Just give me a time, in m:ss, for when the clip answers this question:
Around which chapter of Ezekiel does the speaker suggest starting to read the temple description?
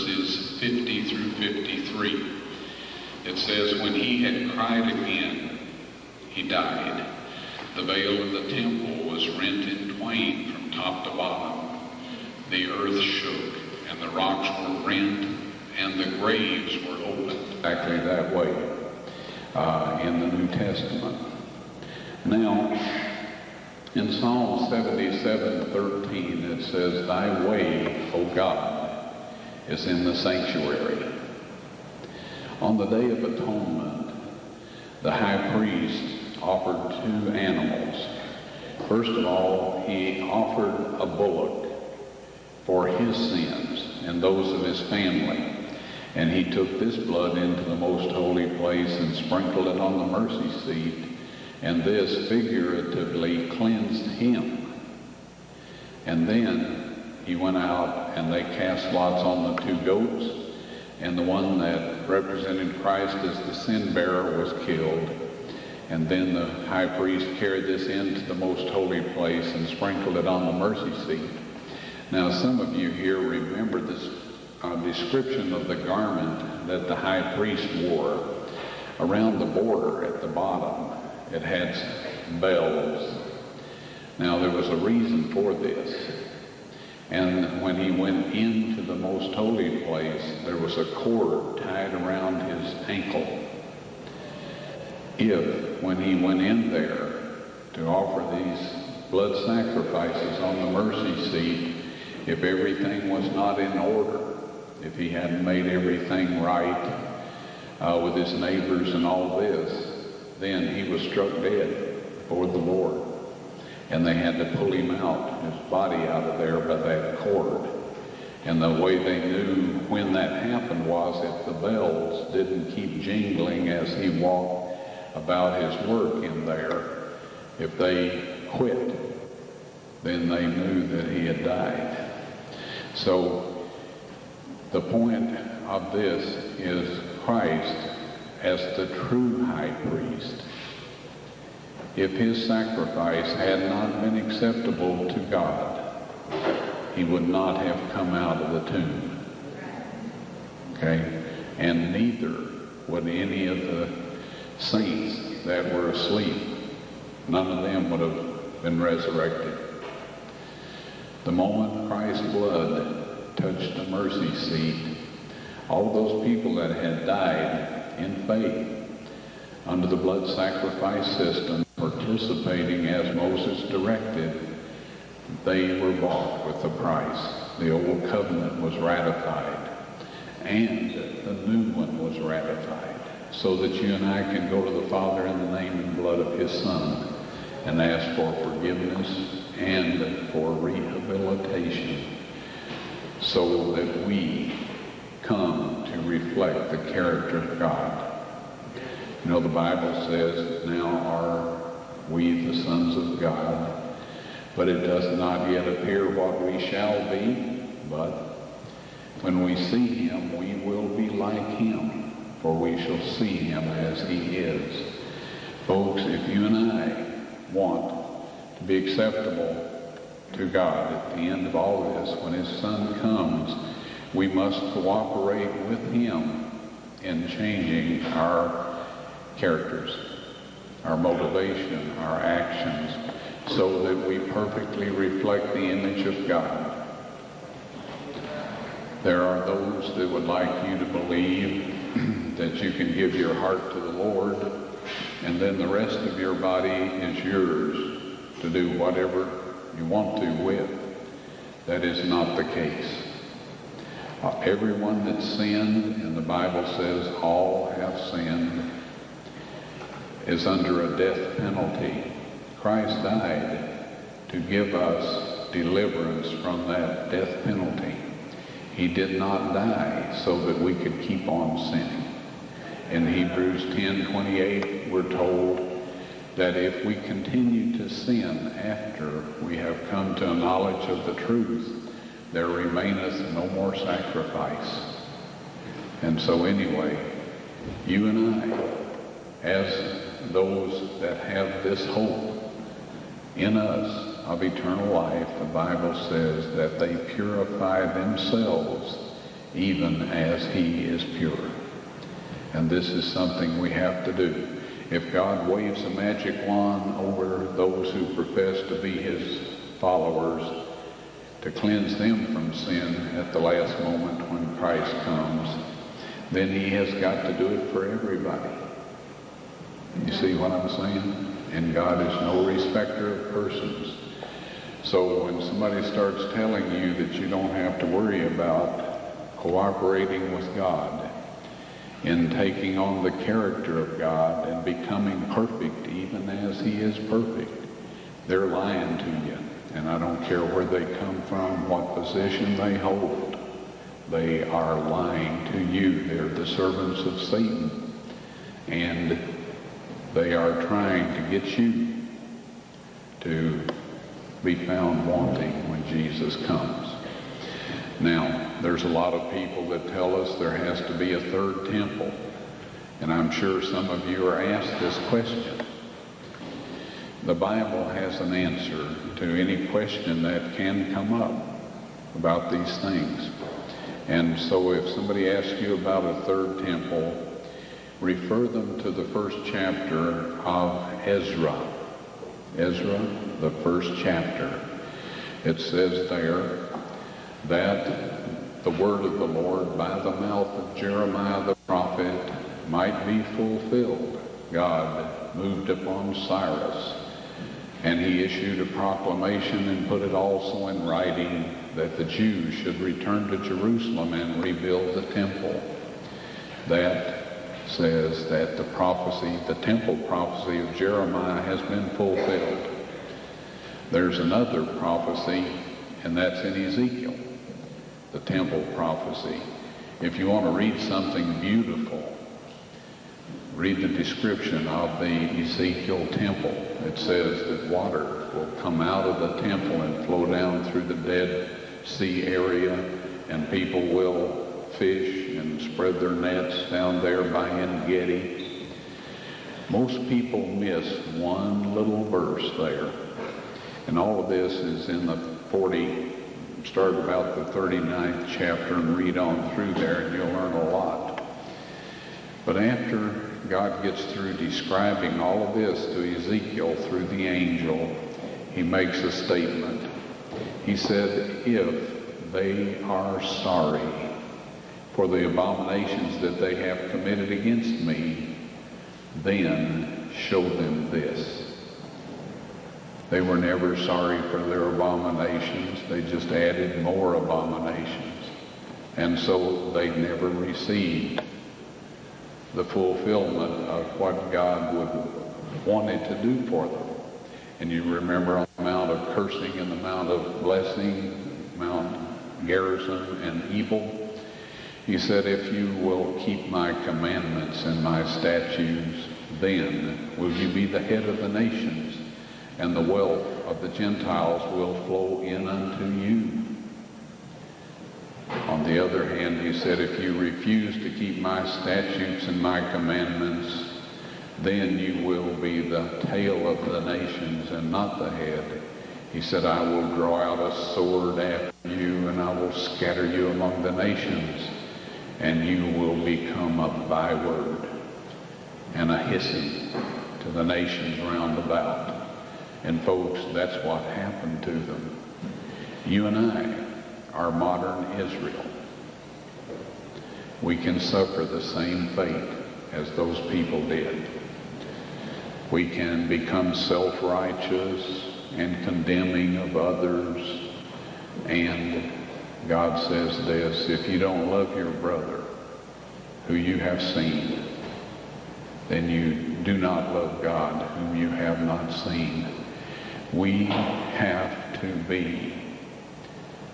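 7:27.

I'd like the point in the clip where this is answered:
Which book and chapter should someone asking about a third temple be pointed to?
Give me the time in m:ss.
6:18.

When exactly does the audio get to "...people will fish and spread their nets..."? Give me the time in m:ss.
7:13.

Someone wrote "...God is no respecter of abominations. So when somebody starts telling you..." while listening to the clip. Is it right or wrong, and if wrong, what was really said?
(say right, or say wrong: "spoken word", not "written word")
wrong: "persons", not "abominations".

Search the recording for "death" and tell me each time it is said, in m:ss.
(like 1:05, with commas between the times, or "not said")
4:20, 4:27.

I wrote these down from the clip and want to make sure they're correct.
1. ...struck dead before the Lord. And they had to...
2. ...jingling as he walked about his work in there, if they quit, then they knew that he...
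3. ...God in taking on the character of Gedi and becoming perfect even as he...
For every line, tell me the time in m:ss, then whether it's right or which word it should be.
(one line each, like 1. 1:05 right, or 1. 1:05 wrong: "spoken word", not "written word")
1. 1:51 right
2. 2:03 right
3. 5:30 wrong: "God", not "Gedi".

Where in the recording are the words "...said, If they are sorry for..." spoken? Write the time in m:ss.
7:40.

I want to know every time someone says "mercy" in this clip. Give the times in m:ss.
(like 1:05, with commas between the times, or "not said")
0:50, 1:10, 1:40, 2:43.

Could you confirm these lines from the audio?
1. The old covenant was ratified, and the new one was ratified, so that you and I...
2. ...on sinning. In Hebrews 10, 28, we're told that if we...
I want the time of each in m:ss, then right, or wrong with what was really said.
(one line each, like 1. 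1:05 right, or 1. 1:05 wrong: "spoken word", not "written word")
1. 2:57 right
2. 4:31 right.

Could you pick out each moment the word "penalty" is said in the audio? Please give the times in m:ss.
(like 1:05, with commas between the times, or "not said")
4:21, 4:27.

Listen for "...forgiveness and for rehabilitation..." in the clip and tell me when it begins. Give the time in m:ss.
3:08.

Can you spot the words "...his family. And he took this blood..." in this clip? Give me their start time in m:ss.
0:44.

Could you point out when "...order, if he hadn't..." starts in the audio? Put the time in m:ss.
1:43.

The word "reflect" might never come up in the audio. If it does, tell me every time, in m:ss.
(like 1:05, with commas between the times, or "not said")
3:16, 3:54.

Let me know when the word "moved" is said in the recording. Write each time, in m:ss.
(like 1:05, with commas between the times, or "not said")
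6:35.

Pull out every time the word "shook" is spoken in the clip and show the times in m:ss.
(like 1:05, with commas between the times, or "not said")
0:12.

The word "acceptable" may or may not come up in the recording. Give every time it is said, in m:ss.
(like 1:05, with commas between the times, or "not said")
2:24, 3:38.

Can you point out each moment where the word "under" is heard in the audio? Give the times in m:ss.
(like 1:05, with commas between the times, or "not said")
2:49, 4:20.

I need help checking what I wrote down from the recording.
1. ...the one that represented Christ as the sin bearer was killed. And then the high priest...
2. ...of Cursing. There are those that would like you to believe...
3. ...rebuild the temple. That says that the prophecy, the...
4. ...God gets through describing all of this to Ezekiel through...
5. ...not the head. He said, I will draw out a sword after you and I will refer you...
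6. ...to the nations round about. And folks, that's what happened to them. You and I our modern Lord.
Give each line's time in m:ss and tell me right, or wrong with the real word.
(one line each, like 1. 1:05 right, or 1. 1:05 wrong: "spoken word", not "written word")
1. 1:01 right
2. 3:56 wrong: "God", not "Cursing"
3. 6:44 right
4. 7:33 right
5. 8:37 wrong: "scatter", not "refer"
6. 8:50 wrong: "Israel", not "Lord".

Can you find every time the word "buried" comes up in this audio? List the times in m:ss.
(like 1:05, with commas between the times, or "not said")
not said.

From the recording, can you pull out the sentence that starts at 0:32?
On the Day of Atonement, the high priest offered two animals.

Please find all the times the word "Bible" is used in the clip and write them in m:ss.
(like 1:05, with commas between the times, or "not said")
3:19, 4:16, 4:55, 6:07.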